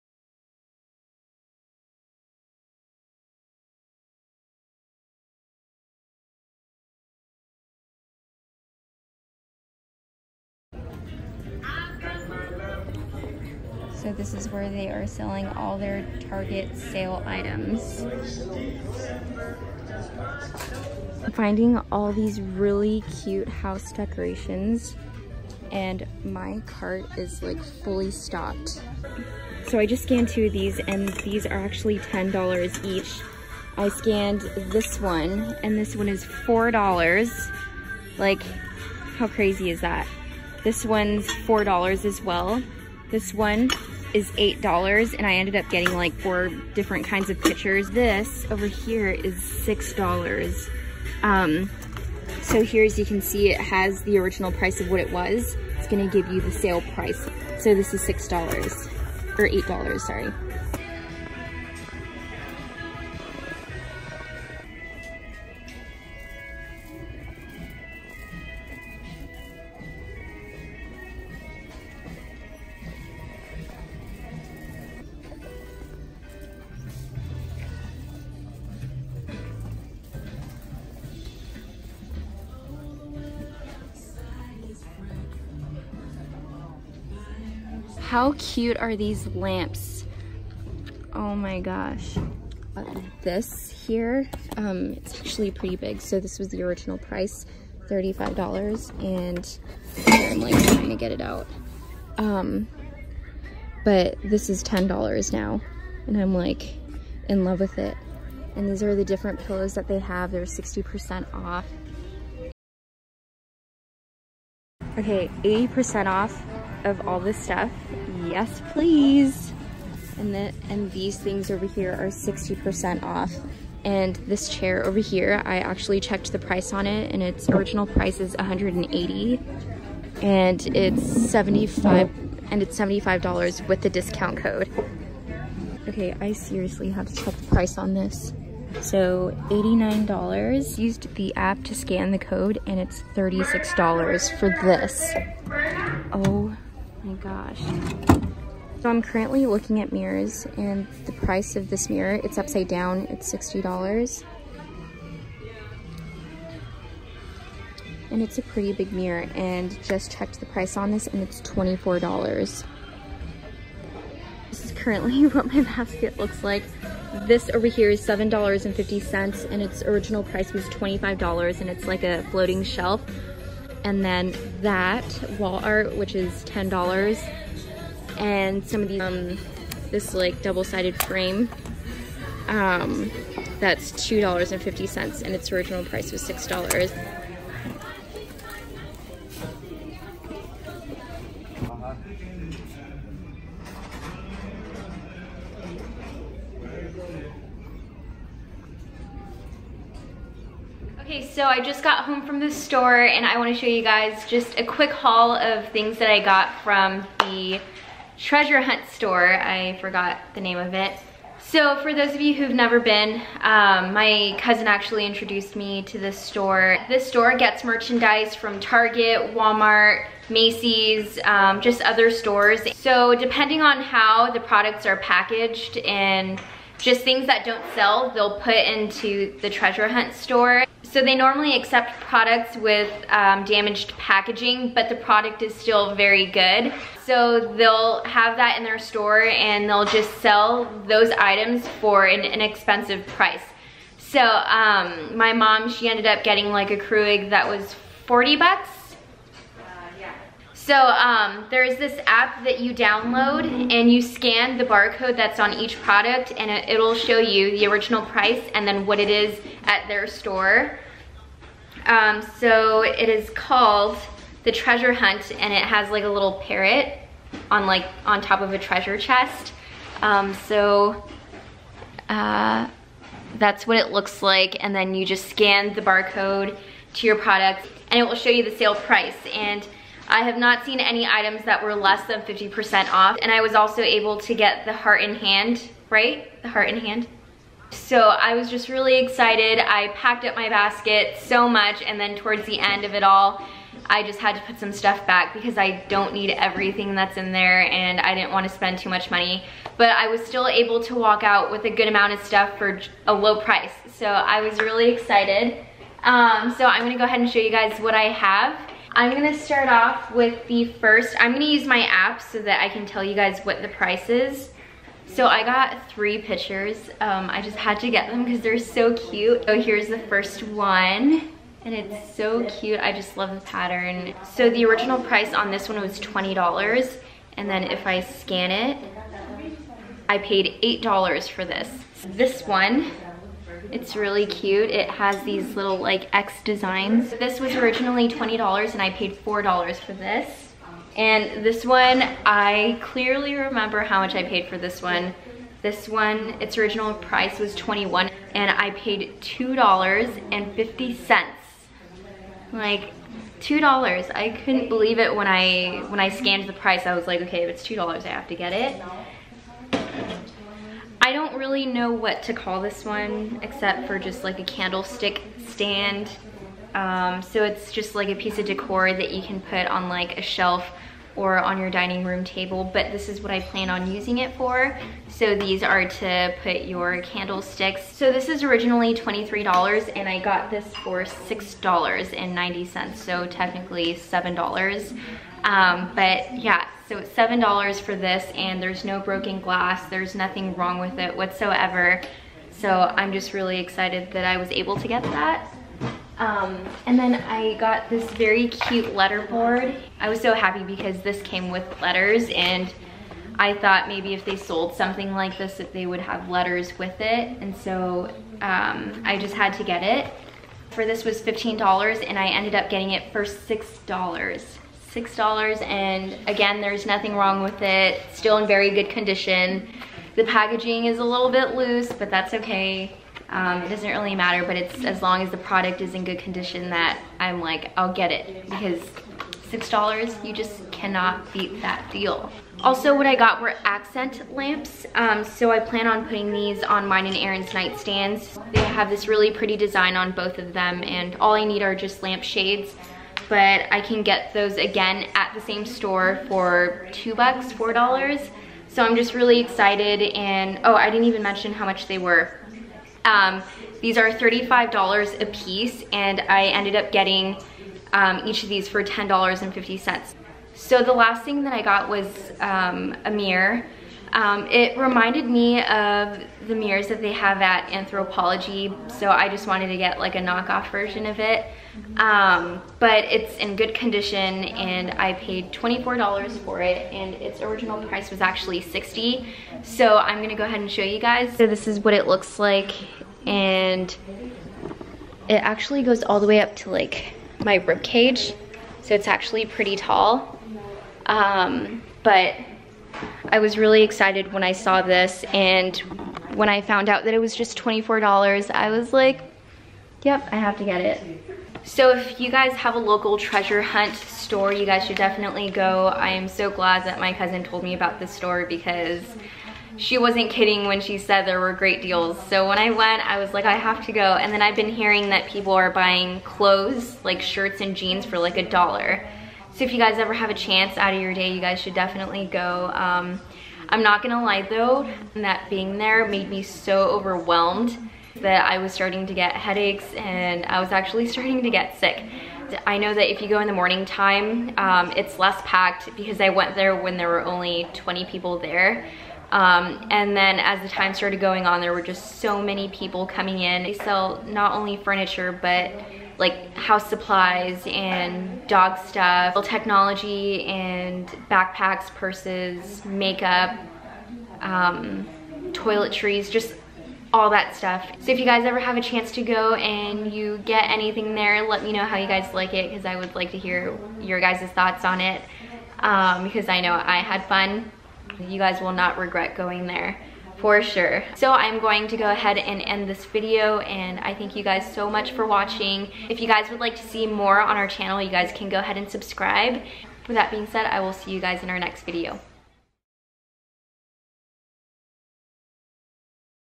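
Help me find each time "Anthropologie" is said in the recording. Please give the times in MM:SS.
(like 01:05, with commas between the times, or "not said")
07:47.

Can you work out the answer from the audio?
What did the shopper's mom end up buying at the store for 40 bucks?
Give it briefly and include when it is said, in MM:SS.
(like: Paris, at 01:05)
a Keurig, at 04:06.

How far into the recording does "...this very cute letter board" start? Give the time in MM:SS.
06:37.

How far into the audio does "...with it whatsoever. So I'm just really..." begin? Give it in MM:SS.
06:30.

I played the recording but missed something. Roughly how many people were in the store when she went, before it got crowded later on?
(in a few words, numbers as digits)
20.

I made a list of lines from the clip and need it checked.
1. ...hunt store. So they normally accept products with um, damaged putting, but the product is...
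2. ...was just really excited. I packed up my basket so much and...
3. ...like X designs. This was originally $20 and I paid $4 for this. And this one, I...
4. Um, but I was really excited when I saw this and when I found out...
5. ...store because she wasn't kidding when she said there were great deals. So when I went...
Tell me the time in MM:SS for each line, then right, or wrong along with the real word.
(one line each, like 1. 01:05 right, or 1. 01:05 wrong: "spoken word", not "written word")
1. 03:49 wrong: "packaging", not "putting"
2. 04:48 right
3. 05:35 right
4. 08:11 right
5. 08:28 right.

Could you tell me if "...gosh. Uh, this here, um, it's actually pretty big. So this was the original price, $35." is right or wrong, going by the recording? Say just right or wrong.
right.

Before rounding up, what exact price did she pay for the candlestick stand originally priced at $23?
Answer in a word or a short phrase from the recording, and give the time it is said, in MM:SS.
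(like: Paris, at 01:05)
$6.90, at 06:21.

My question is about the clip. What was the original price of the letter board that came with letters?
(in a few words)
$15.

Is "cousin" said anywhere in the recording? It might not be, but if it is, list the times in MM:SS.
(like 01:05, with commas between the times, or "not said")
03:34, 08:27.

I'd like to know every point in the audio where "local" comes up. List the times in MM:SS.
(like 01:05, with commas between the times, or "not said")
08:22.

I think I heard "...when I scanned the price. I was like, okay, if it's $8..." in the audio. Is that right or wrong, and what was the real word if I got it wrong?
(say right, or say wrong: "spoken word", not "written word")
wrong: "2", not "8".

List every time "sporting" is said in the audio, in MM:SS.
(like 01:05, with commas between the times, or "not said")
not said.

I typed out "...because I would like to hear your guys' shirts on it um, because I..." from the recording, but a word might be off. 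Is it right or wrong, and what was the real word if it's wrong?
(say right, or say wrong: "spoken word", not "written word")
wrong: "thoughts", not "shirts".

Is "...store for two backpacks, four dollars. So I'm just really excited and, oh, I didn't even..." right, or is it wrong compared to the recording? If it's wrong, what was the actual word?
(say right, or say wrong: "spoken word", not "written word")
wrong: "bucks", not "backpacks".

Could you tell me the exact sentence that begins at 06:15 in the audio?
So these are to put your candlesticks.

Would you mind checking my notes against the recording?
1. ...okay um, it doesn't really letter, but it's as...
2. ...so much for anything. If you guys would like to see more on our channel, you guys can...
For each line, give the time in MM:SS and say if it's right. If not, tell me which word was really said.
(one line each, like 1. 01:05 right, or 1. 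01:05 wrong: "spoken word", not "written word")
1. 07:02 wrong: "matter", not "letter"
2. 09:34 wrong: "watching", not "anything".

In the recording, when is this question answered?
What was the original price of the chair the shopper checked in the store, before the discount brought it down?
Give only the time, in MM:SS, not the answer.
02:08.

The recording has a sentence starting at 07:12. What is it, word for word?
Also what I got were accent lamps, um, so I plan on putting these on mine and Aaron's nightstands.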